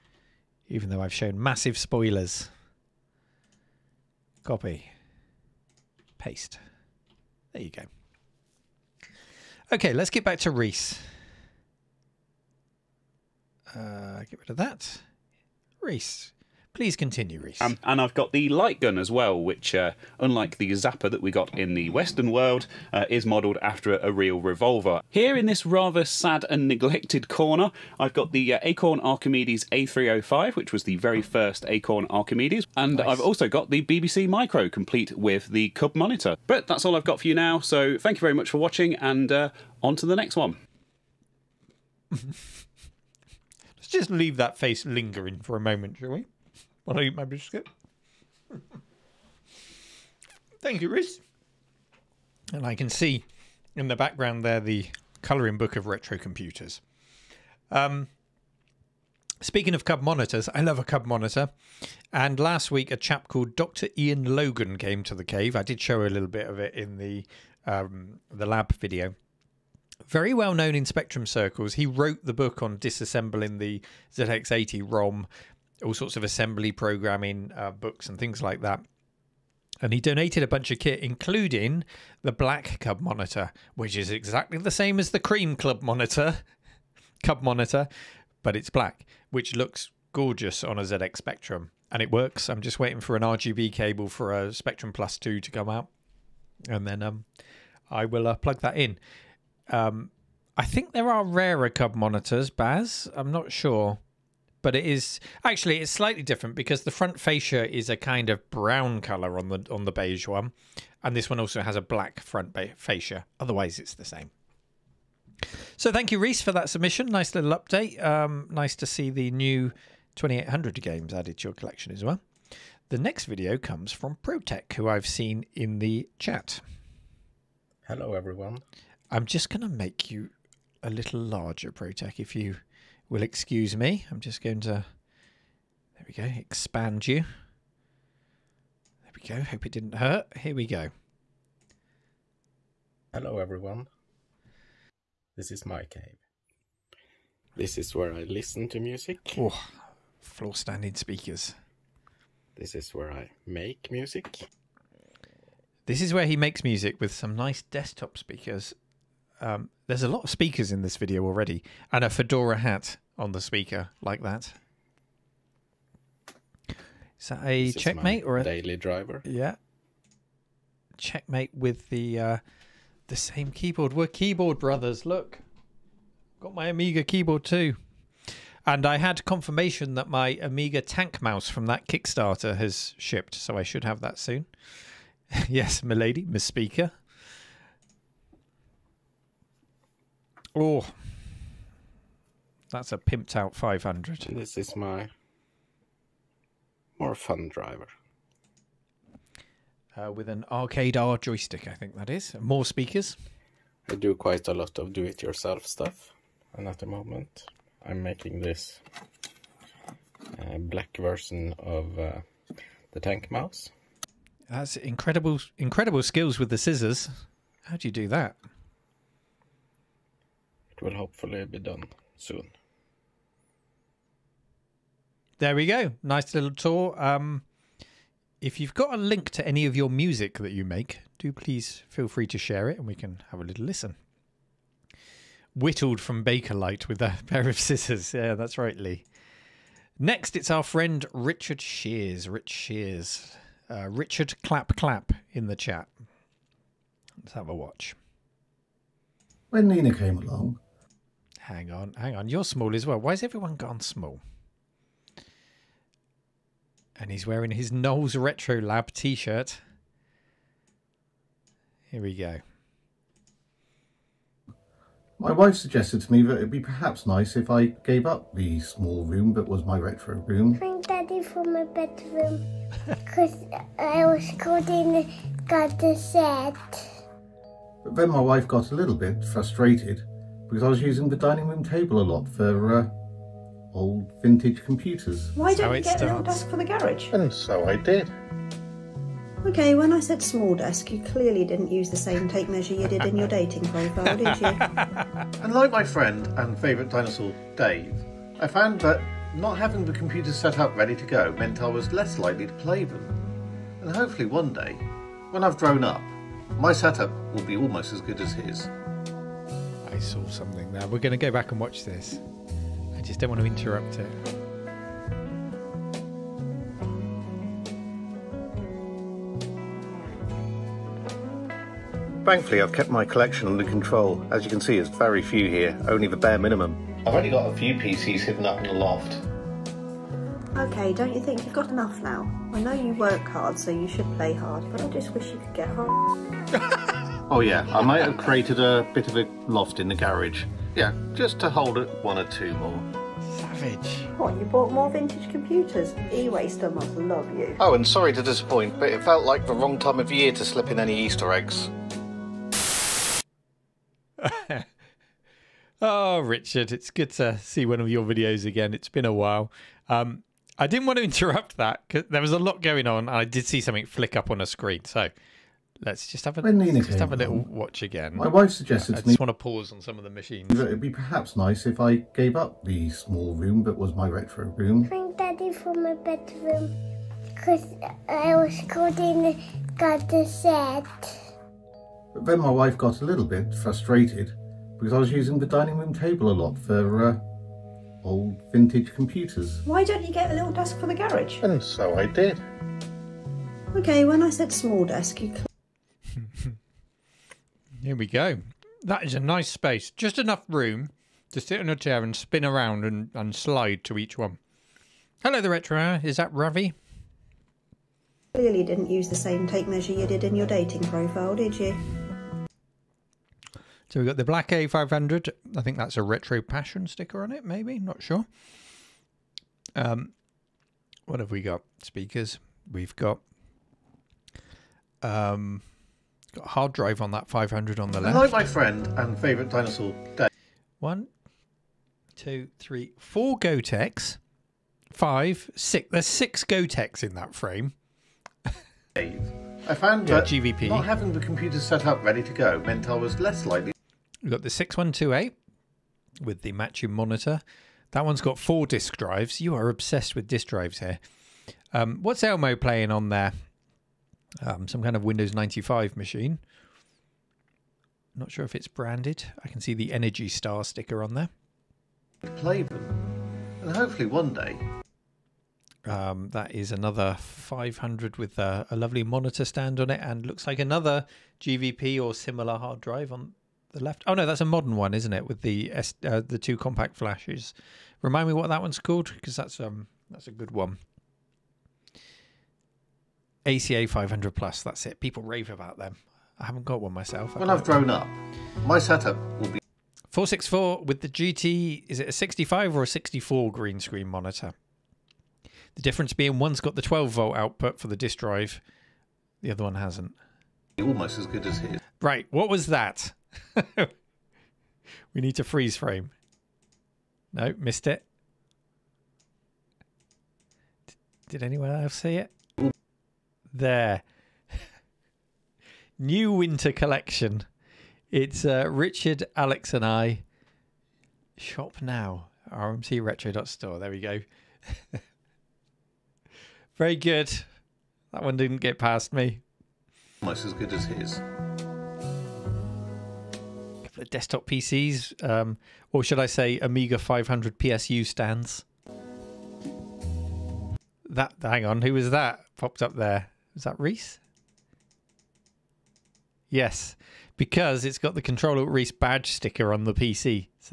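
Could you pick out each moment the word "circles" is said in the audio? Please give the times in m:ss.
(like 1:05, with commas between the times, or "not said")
1:11.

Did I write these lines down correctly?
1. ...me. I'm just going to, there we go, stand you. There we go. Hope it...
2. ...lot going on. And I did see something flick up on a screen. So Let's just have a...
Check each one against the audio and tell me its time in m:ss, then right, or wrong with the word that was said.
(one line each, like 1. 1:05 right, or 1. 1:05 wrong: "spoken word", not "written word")
1. 2:13 wrong: "expand", not "stand"
2. 6:02 right.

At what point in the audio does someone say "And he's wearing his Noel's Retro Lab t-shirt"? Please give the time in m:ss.
4:16.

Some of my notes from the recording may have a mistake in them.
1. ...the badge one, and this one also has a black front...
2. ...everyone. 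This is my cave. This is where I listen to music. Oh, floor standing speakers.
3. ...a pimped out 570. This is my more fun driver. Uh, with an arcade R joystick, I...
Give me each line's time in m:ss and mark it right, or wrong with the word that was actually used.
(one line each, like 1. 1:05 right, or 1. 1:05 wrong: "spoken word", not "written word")
1. 1:49 wrong: "beige", not "badge"
2. 2:23 right
3. 3:12 wrong: "500", not "570".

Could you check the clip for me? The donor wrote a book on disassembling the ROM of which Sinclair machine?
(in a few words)
ZX80.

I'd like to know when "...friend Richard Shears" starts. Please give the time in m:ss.
4:00.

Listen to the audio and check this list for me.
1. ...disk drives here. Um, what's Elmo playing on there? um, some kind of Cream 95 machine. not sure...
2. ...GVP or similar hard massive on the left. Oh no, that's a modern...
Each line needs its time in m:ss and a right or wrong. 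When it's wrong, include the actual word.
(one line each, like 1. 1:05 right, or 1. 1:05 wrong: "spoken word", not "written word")
1. 7:30 wrong: "Windows", not "Cream"
2. 7:51 wrong: "drive", not "massive".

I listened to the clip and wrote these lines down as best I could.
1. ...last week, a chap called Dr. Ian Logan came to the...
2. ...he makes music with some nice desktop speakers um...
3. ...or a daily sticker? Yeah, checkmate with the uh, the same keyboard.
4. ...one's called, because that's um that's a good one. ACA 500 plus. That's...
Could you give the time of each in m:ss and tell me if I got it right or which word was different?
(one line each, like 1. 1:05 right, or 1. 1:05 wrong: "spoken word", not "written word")
1. 1:02 right
2. 2:36 right
3. 2:48 wrong: "driver", not "sticker"
4. 7:58 right.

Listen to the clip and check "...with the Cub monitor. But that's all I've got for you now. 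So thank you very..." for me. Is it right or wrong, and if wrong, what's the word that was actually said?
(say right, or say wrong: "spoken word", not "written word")
right.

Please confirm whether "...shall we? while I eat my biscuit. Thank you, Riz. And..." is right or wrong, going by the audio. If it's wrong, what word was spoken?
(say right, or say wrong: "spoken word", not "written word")
right.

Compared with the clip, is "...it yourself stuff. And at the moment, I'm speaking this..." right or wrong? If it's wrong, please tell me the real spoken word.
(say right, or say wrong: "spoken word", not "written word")
wrong: "making", not "speaking".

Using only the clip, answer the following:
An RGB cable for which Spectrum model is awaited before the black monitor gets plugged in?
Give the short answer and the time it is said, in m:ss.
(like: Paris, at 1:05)
Spectrum Plus 2, at 1:34.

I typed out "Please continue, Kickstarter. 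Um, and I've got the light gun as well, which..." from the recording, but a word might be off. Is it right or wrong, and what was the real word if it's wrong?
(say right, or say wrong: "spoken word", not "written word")
wrong: "Reese", not "Kickstarter".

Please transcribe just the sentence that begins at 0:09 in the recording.
Okay, let's get back to Reese.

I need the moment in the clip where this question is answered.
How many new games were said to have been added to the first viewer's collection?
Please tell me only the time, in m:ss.
2:00.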